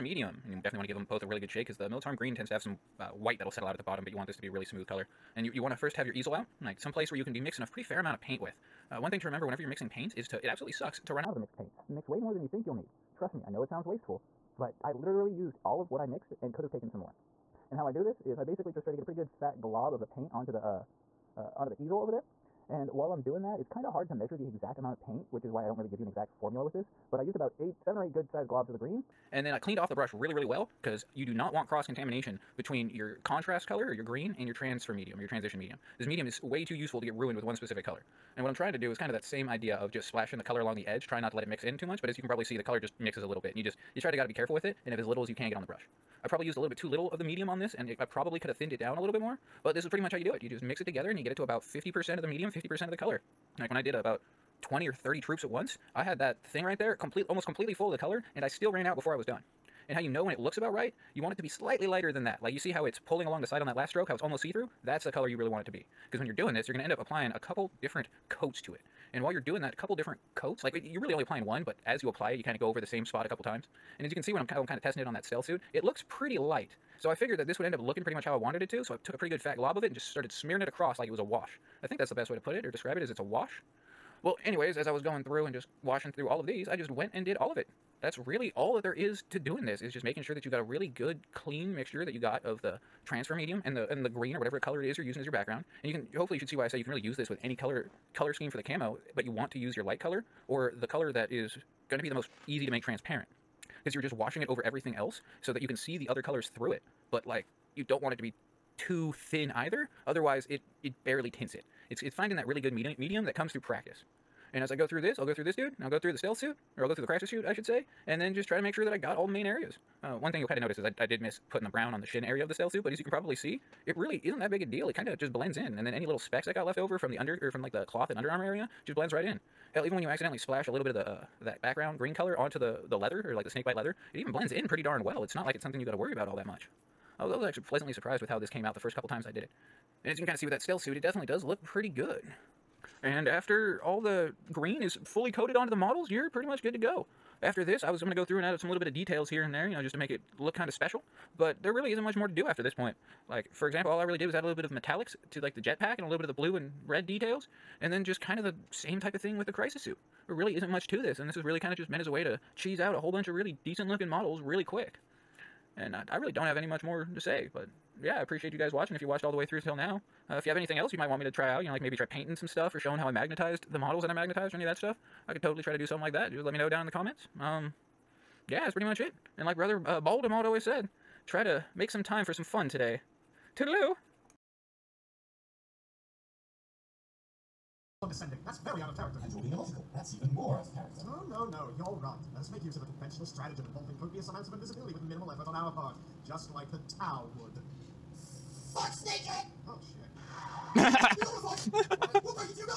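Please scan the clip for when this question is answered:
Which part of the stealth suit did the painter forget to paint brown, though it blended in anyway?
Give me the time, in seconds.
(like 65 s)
122 s.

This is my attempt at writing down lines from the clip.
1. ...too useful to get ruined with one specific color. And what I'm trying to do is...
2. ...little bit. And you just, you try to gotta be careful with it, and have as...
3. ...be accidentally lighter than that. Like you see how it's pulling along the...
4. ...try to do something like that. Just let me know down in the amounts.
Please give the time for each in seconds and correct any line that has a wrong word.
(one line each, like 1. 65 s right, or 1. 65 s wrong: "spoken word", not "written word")
1. 36 s right
2. 43 s right
3. 61 s wrong: "slightly", not "accidentally"
4. 175 s wrong: "comments", not "amounts".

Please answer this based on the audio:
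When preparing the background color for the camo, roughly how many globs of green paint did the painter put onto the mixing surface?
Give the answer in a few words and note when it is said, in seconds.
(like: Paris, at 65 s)
7 or 8, at 27 s.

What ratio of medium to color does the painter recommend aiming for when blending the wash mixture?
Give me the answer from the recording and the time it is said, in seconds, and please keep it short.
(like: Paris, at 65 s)
50% medium, 50% color, at 51 s.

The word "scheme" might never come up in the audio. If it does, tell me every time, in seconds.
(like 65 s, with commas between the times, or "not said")
98 s.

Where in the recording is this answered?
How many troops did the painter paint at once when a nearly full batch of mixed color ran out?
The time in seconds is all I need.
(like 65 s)
54 s.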